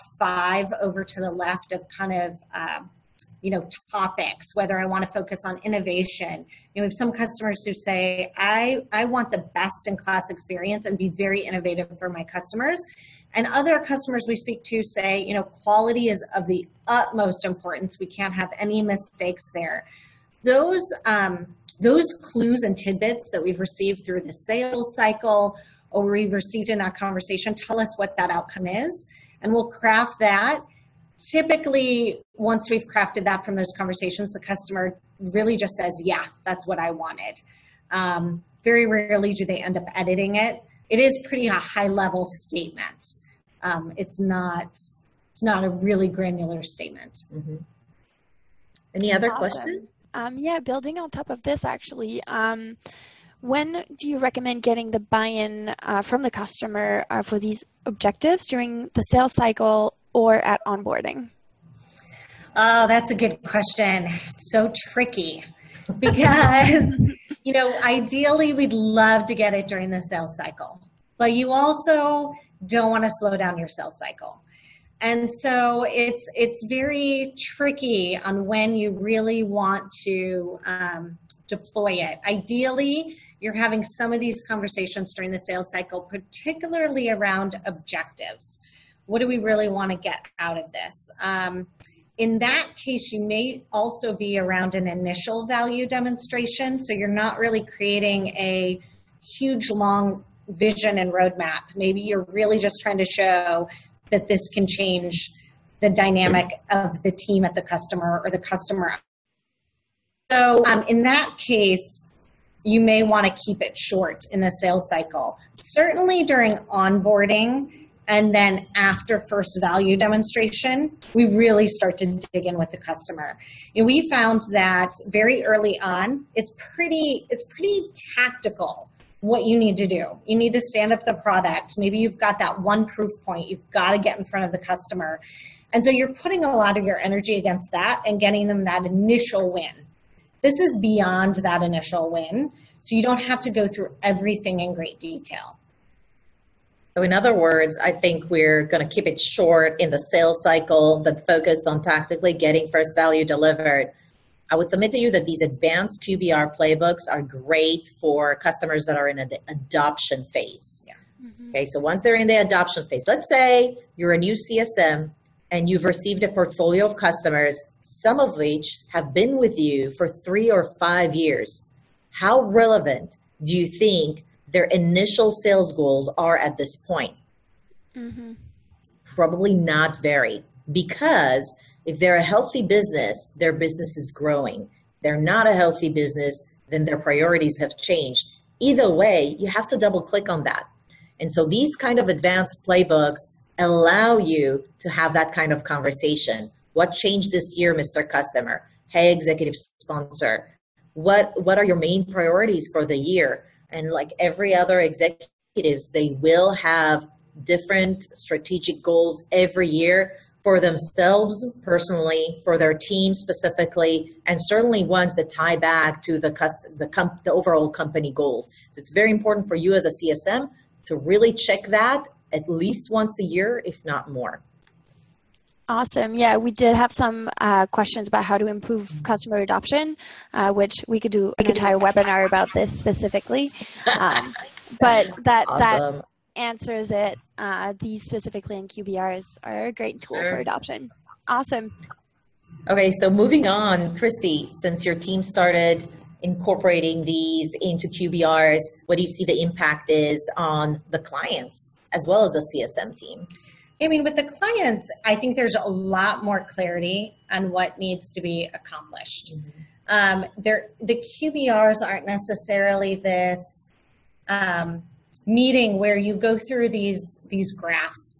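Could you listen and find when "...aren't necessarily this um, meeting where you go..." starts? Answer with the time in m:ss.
4:21.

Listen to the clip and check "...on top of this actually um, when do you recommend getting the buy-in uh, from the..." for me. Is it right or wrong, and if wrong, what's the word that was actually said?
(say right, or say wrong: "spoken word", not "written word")
right.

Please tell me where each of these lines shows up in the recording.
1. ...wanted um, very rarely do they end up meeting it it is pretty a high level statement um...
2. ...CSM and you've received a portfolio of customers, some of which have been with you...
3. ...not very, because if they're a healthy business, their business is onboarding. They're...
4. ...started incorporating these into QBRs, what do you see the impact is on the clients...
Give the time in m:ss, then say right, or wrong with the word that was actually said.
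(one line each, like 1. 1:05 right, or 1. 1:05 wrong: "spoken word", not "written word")
1. 0:36 wrong: "editing", not "meeting"
2. 2:44 right
3. 2:59 wrong: "growing", not "onboarding"
4. 4:05 right.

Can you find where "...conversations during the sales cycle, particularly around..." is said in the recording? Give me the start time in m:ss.
1:24.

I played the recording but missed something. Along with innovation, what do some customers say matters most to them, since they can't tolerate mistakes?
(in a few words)
Quality.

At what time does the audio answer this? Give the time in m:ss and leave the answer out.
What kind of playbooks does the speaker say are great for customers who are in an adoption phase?
2:35.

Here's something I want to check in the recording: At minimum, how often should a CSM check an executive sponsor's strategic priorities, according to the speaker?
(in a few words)
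Once a year.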